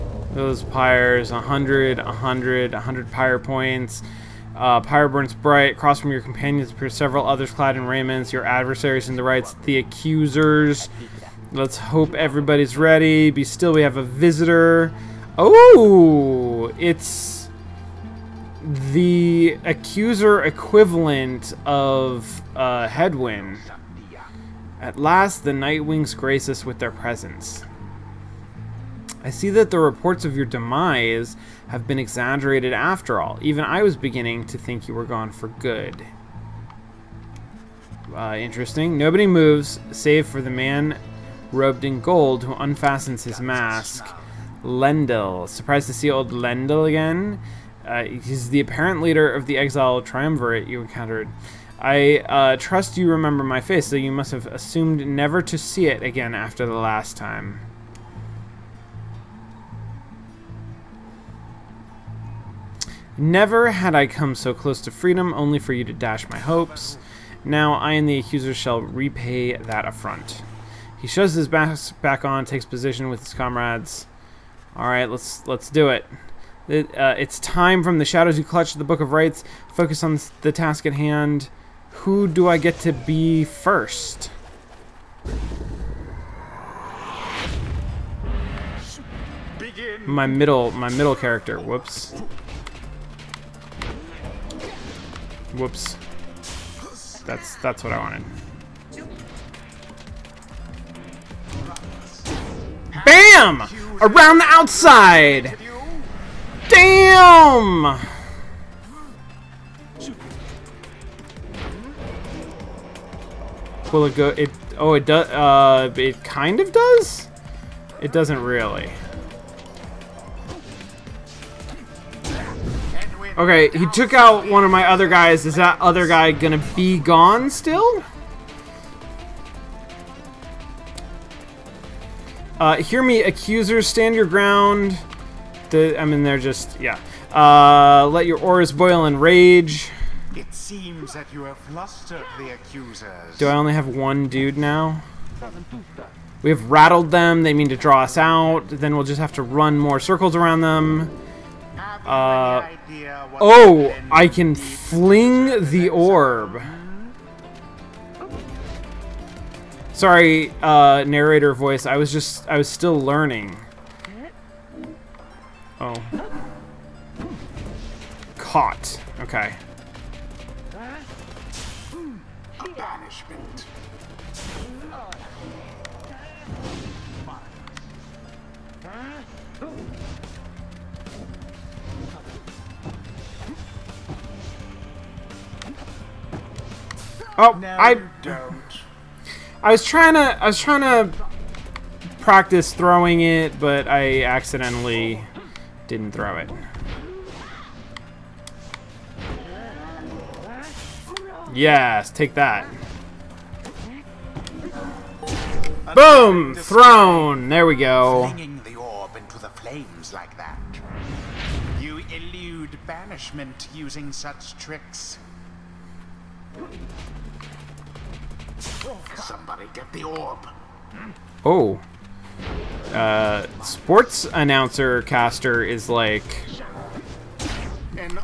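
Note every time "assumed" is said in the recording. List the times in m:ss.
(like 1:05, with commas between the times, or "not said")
0:54.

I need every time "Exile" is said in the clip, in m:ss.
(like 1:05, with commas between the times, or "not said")
0:49.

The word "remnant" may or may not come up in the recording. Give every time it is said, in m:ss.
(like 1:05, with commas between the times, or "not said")
not said.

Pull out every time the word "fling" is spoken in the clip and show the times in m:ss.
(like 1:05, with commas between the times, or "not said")
2:34.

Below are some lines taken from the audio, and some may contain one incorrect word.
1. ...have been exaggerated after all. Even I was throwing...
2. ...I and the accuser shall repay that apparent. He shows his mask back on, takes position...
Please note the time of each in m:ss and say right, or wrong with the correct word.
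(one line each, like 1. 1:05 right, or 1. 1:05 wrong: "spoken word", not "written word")
1. 0:31 wrong: "beginning", not "throwing"
2. 1:07 wrong: "affront", not "apparent".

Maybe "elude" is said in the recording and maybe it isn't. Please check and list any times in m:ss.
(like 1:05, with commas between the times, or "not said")
3:31.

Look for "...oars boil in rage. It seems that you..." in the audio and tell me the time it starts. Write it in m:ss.
2:18.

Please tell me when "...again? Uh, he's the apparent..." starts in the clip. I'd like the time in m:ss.
0:46.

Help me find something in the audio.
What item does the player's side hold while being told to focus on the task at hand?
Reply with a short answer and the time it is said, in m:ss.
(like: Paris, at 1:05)
Book of Rites, at 1:18.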